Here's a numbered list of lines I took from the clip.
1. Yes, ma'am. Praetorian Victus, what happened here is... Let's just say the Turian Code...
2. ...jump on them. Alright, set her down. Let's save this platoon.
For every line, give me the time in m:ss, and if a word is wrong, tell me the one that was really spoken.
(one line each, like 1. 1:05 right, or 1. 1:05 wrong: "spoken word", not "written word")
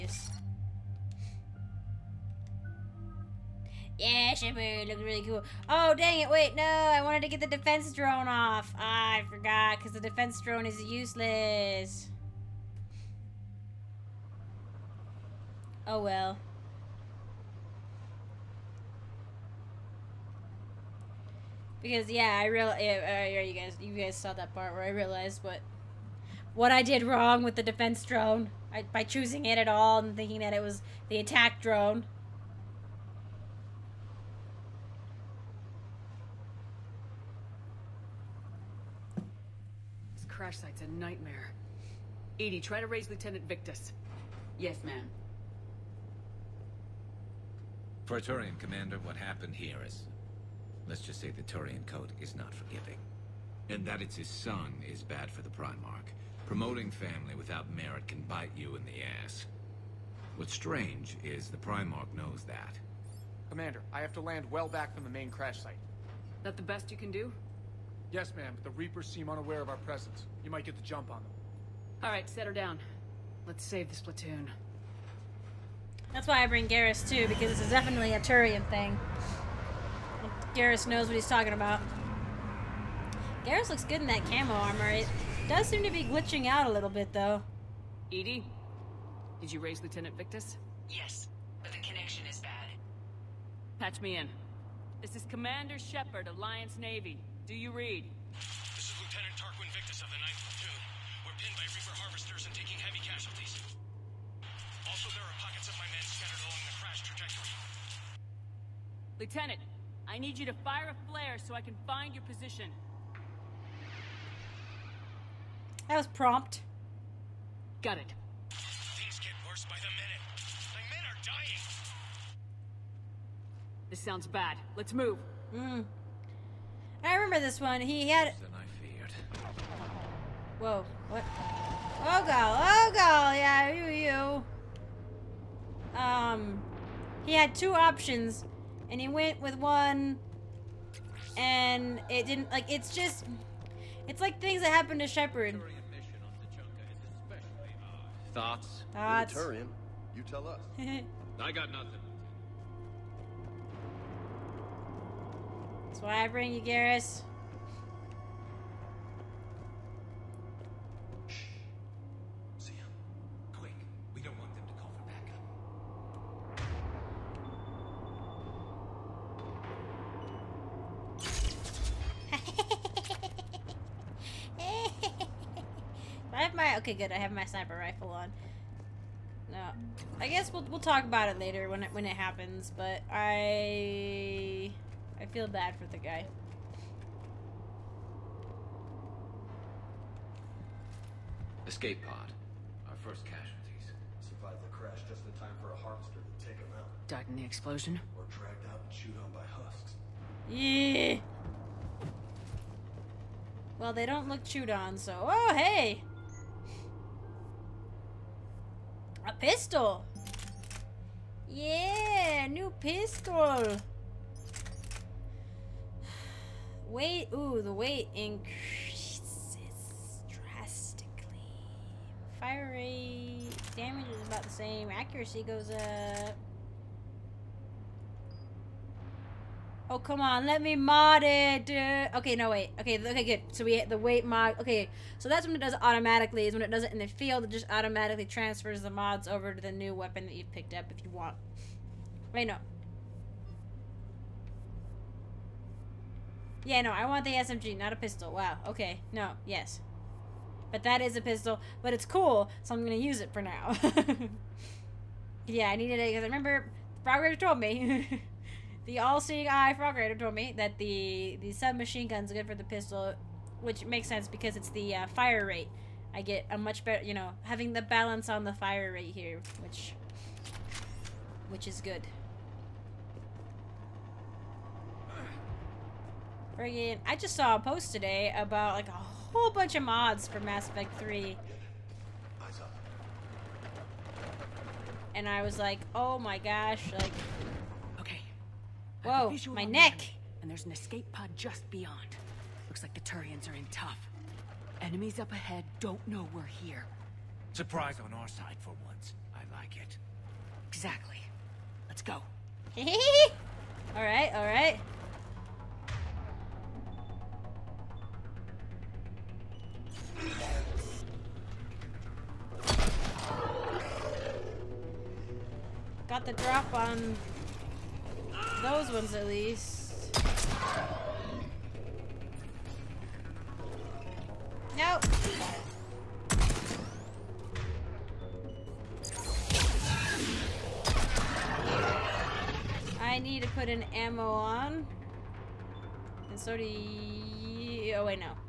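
1. 0:44 wrong: "Commander", not "Victus"
2. 1:10 right.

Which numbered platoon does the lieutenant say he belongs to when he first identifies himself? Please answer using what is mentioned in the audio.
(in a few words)
9th.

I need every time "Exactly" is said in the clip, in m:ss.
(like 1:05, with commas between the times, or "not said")
5:00.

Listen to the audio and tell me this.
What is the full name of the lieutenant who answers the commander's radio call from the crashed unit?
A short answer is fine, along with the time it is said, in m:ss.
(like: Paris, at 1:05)
Tarquin Victus, at 1:39.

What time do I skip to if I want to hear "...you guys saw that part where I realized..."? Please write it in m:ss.
0:23.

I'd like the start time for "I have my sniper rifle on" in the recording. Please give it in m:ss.
2:57.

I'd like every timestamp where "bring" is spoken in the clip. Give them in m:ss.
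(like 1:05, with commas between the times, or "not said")
1:16, 2:36.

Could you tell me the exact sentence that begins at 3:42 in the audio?
Fire rate, damage is about the same, accuracy goes up.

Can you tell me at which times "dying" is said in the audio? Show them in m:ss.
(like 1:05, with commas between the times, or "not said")
2:01.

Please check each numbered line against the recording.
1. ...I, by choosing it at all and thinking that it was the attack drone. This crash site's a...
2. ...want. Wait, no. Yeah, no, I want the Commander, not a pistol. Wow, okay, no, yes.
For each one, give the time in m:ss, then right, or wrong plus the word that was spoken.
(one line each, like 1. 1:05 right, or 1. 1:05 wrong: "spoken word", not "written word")
1. 0:28 right
2. 4:01 wrong: "SMG", not "Commander".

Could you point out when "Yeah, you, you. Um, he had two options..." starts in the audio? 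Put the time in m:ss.
2:13.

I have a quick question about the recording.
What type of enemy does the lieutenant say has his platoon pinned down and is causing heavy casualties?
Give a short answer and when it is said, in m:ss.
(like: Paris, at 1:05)
Reaper Harvesters, at 1:41.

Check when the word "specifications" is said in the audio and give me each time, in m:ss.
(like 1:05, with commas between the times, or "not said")
not said.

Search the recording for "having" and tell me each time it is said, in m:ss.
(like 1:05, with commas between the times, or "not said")
4:27.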